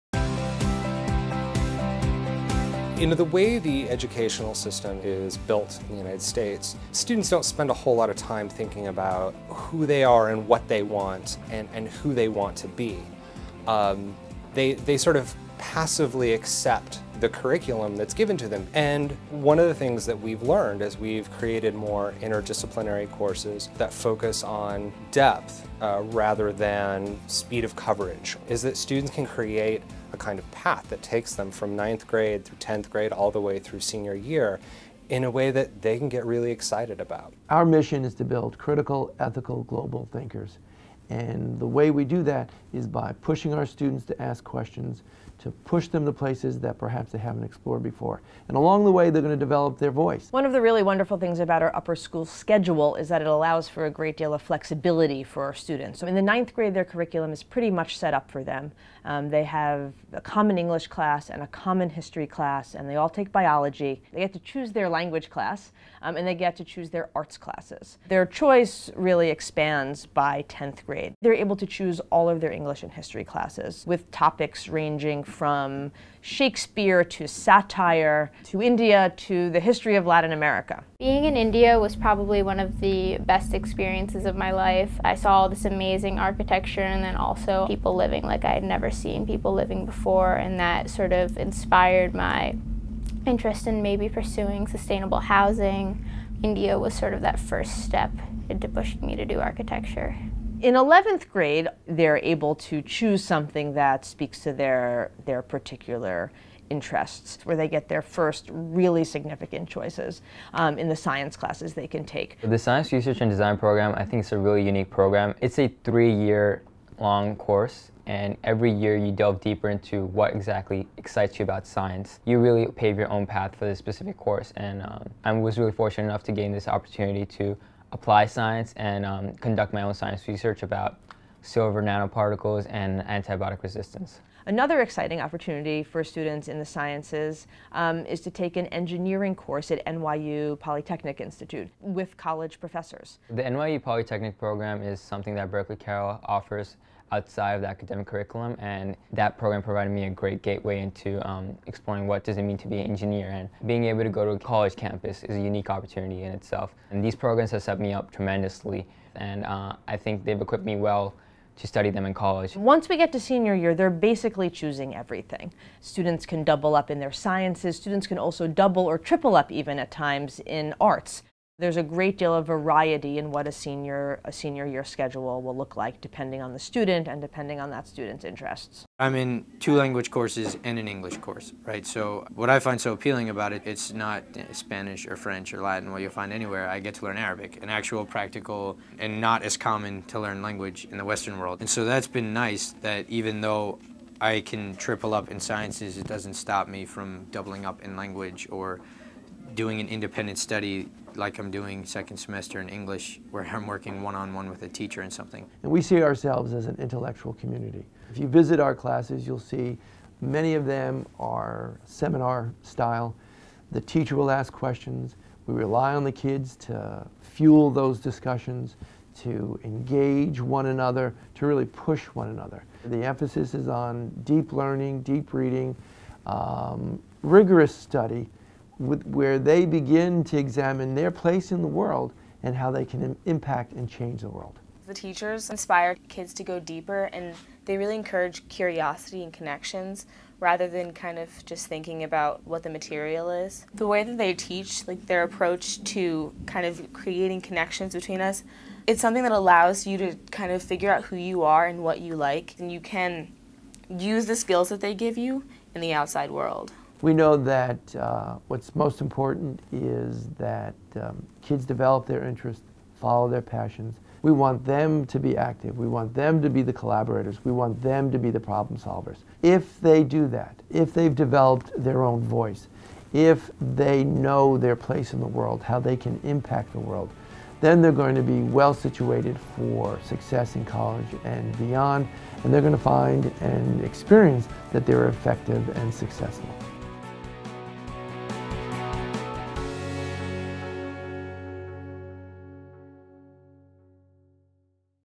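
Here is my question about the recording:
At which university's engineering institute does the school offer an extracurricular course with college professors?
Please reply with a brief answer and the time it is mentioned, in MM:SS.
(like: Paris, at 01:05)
NYU Polytechnic Institute, at 02:19.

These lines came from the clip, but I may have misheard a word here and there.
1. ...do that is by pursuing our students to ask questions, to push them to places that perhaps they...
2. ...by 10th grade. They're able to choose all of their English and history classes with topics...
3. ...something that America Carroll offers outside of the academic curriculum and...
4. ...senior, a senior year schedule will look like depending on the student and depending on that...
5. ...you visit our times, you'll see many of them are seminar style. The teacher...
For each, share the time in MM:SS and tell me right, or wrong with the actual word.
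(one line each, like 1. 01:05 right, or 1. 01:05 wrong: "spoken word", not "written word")
1. 00:42 wrong: "pushing", not "pursuing"
2. 01:10 right
3. 02:24 wrong: "Berkeley", not "America"
4. 02:53 right
5. 03:28 wrong: "classes", not "times".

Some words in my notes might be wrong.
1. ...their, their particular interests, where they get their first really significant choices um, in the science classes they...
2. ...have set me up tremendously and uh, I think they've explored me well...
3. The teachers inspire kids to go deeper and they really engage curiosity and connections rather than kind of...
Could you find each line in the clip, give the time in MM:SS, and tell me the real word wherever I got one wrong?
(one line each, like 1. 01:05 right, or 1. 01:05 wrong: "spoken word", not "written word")
1. 01:44 right
2. 02:37 wrong: "equipped", not "explored"
3. 03:54 wrong: "encourage", not "engage".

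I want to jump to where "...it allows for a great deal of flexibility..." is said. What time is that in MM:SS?
00:53.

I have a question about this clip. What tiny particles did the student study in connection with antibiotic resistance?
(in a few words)
silver nanoparticles.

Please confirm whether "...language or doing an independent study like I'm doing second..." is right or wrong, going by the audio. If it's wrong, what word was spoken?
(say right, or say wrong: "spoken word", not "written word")
right.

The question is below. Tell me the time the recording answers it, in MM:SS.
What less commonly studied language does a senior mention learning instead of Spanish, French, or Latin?
03:07.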